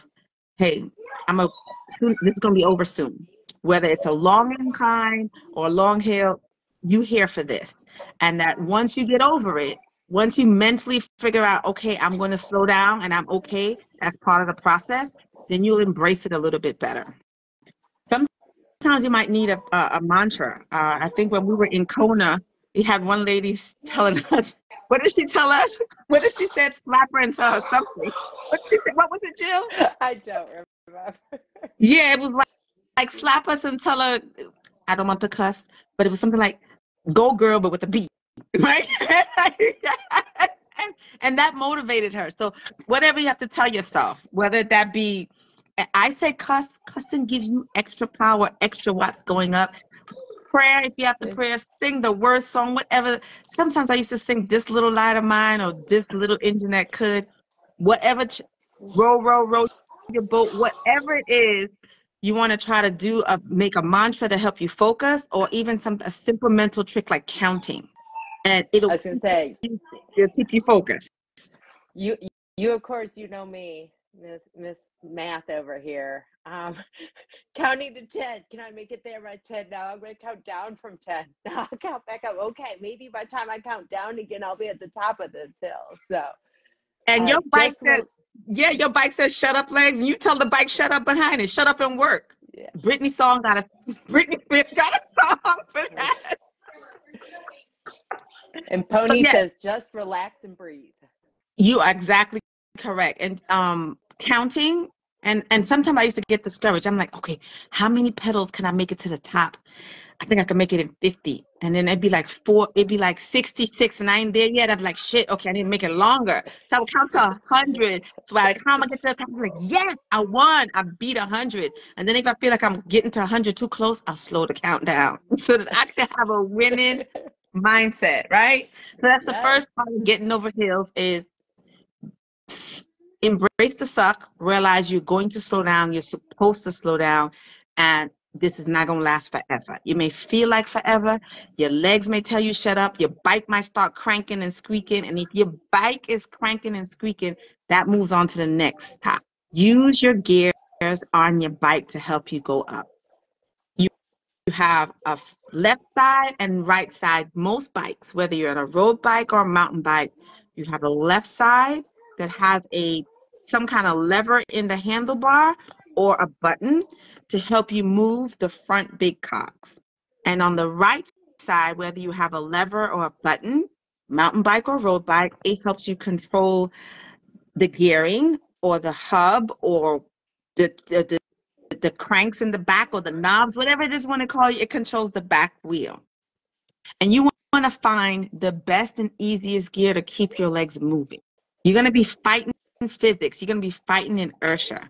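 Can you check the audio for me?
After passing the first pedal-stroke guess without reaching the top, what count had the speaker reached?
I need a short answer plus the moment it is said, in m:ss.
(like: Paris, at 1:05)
66, at 1:53.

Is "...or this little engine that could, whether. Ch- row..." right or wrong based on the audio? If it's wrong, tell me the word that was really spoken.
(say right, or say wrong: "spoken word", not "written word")
wrong: "whatever", not "whether".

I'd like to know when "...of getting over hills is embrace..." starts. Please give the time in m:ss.
2:09.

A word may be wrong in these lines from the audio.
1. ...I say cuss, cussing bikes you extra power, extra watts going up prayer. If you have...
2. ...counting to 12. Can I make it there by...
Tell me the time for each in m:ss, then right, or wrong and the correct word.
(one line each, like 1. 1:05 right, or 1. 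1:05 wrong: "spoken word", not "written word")
1. 0:45 wrong: "gives", not "bikes"
2. 1:17 wrong: "10", not "12".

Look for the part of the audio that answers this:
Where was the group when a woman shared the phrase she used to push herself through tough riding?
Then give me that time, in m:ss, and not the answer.
0:21.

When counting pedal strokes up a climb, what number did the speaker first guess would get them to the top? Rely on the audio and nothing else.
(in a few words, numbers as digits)
50.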